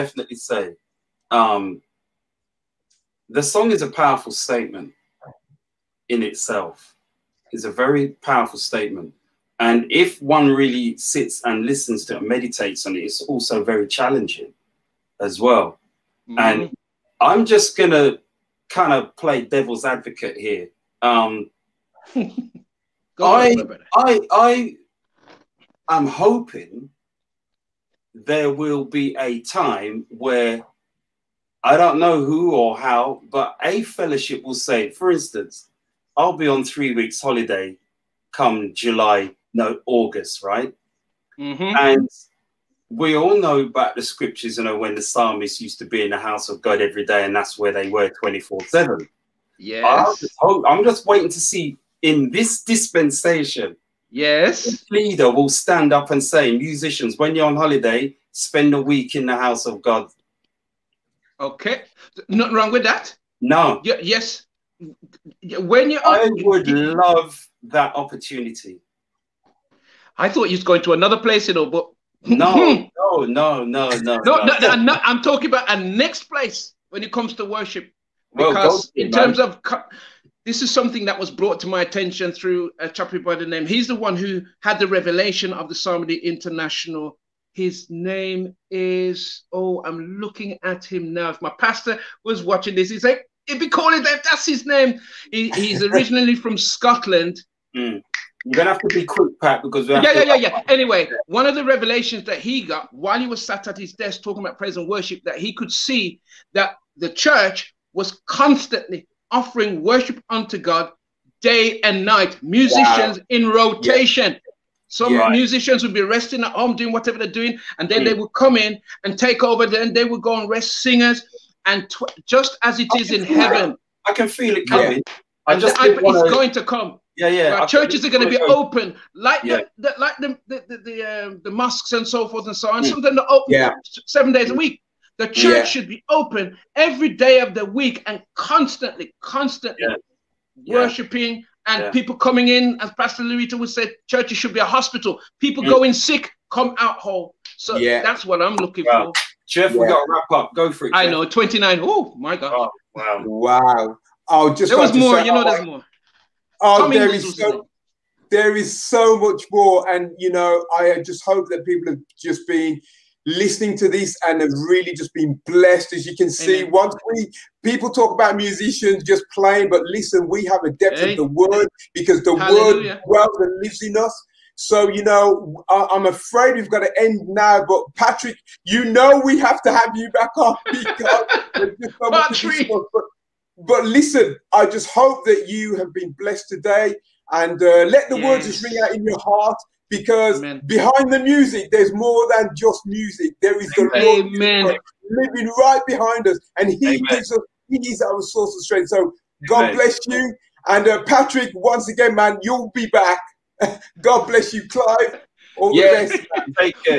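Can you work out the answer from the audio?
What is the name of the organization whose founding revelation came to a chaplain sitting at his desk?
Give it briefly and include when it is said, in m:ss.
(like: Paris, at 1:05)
Psalmody International, at 1:25.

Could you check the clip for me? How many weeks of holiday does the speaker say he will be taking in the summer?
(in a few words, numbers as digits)
3.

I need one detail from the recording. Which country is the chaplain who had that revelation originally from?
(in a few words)
Scotland.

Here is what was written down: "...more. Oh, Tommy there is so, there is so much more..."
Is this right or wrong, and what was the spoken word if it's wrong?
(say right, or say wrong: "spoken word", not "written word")
right.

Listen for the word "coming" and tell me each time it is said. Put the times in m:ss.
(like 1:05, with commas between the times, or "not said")
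2:04, 2:22.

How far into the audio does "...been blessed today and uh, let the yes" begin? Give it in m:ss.
3:05.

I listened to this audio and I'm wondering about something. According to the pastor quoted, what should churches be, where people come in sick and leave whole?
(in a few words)
A hospital.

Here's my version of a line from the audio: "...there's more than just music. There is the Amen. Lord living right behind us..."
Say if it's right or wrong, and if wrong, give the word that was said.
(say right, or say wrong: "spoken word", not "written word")
right.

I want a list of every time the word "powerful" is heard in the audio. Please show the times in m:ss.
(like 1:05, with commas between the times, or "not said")
0:03, 0:08.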